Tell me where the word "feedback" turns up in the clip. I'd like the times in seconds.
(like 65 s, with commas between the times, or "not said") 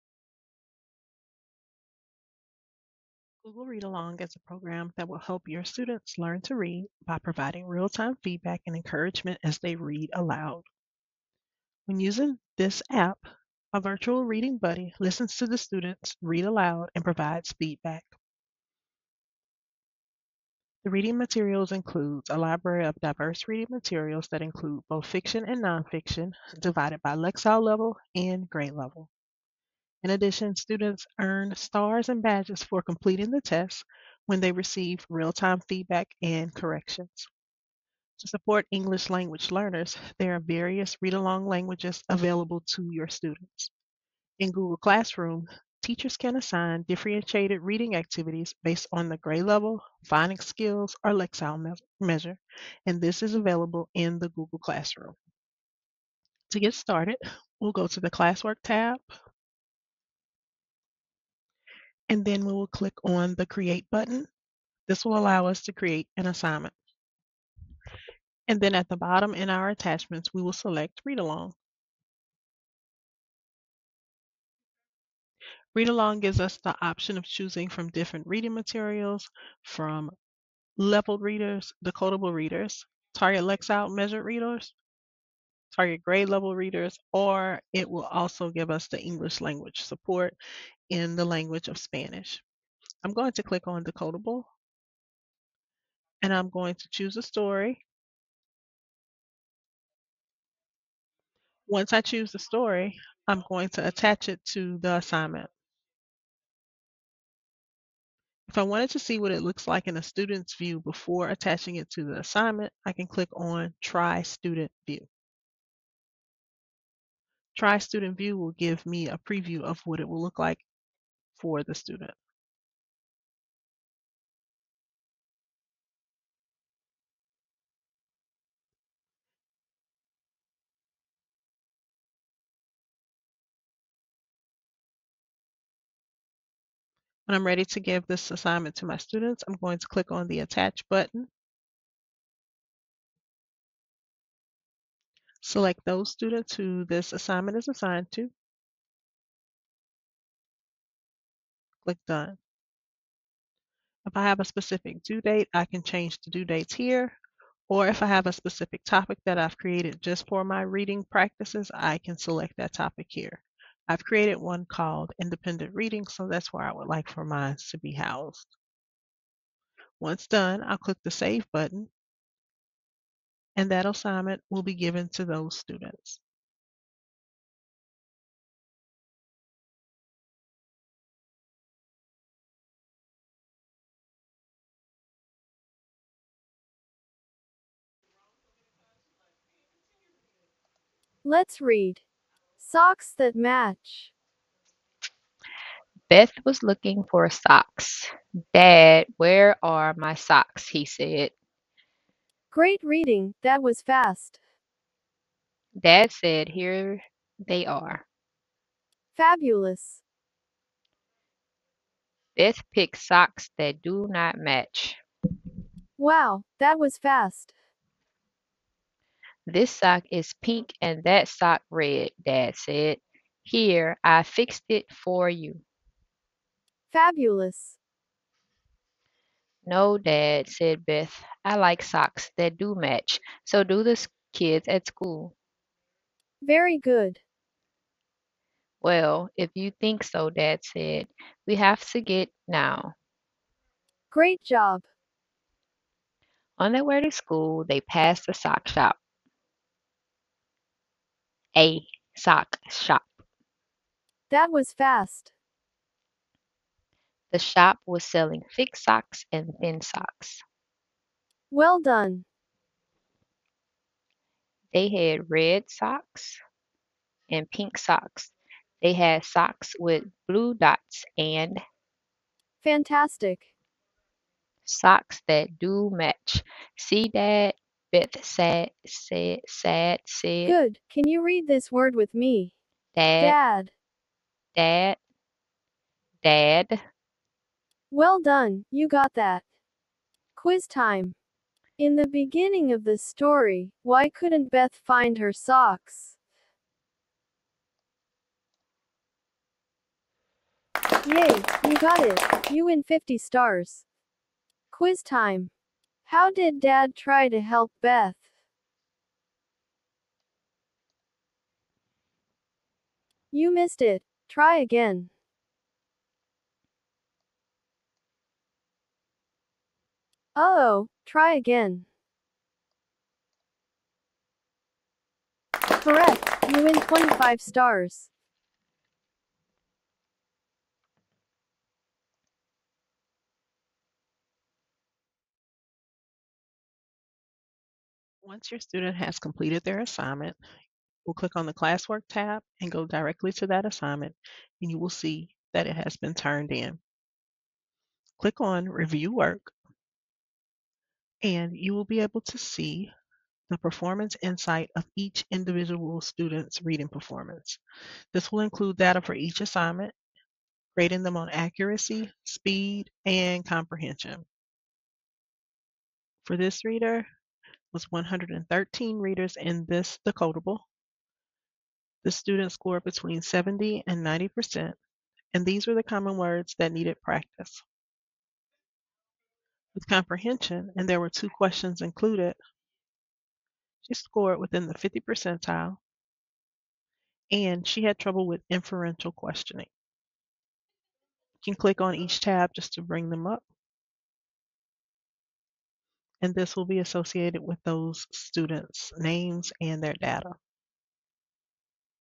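8 s, 17 s, 35 s.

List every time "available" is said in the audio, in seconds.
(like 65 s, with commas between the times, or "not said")
42 s, 53 s.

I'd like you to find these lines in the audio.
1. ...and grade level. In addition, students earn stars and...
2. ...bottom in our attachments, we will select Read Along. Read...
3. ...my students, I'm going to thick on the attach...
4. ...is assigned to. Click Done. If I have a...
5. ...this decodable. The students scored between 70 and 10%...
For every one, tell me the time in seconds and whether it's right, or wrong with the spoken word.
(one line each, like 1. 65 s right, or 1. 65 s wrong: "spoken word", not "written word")
1. 28 s right
2. 68 s right
3. 138 s wrong: "click", not "thick"
4. 147 s right
5. 369 s wrong: "90", not "10".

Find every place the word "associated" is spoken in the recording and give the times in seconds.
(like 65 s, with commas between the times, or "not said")
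396 s.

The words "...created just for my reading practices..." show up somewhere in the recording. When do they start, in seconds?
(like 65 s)
159 s.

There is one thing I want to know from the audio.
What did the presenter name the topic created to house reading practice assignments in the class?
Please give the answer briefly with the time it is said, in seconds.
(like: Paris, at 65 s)
independent reading, at 165 s.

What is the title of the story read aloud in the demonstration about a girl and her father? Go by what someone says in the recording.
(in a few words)
Socks that match.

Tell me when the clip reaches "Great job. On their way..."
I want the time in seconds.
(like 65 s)
244 s.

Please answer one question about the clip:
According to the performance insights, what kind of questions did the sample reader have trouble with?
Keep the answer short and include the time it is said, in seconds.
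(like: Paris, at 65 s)
inferential questioning, at 388 s.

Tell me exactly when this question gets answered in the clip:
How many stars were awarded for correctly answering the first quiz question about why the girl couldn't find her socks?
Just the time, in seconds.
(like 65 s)
302 s.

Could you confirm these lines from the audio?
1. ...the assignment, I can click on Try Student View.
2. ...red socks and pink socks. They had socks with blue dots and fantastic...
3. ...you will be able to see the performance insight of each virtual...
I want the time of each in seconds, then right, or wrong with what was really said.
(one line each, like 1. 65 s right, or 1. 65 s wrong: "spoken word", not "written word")
1. 112 s right
2. 265 s right
3. 351 s wrong: "individual", not "virtual".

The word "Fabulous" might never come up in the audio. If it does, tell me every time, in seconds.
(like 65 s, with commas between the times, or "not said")
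209 s, 226 s.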